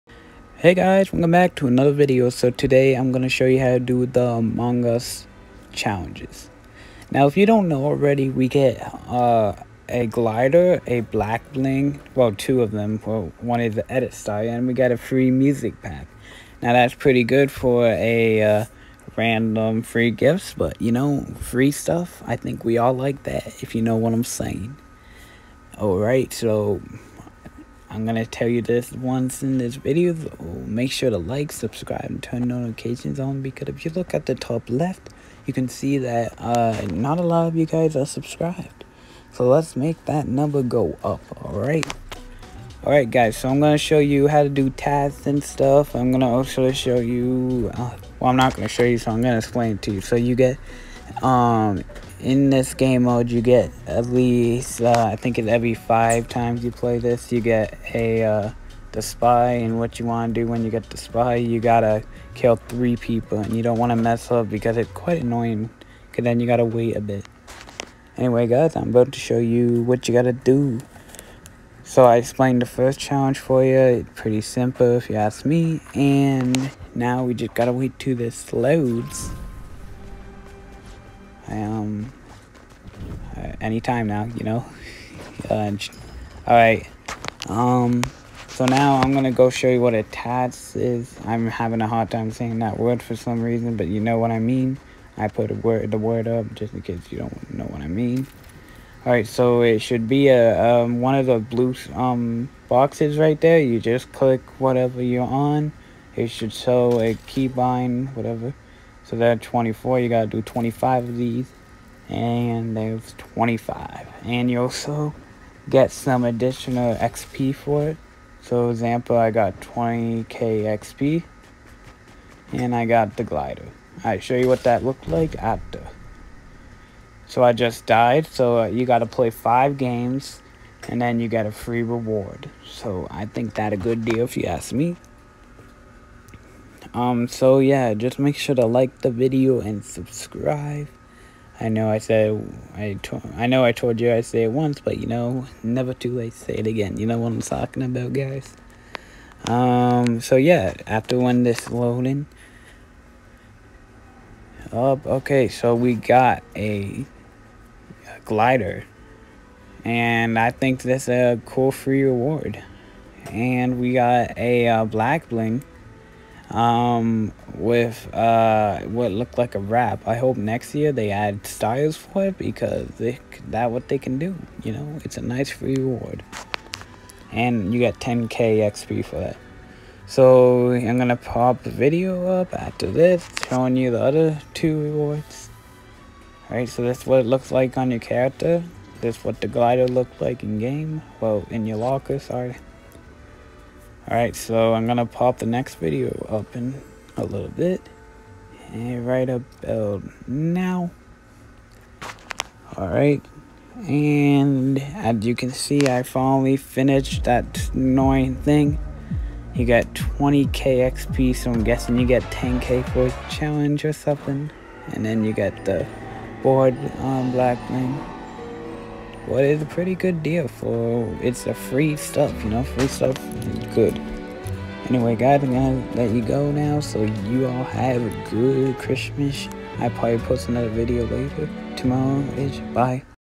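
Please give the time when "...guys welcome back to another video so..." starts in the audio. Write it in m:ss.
0:00.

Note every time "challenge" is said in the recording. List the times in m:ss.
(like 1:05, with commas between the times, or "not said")
0:05, 1:12, 3:33.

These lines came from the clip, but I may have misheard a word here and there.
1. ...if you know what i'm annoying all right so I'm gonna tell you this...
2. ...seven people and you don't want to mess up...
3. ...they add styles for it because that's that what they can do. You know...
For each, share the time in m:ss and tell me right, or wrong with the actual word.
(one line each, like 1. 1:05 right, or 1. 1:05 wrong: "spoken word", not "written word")
1. 0:23 wrong: "saying", not "annoying"
2. 1:02 wrong: "three", not "seven"
3. 2:50 right.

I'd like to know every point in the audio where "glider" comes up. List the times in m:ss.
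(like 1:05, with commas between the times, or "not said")
0:10, 2:03, 2:38, 3:09.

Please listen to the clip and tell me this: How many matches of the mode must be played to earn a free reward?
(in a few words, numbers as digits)
5.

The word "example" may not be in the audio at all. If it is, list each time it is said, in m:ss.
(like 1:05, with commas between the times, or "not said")
1:58.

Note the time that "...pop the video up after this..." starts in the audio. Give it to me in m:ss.
3:01.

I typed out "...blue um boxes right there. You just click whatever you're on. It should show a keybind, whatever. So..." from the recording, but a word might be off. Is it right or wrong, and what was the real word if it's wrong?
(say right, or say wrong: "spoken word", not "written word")
right.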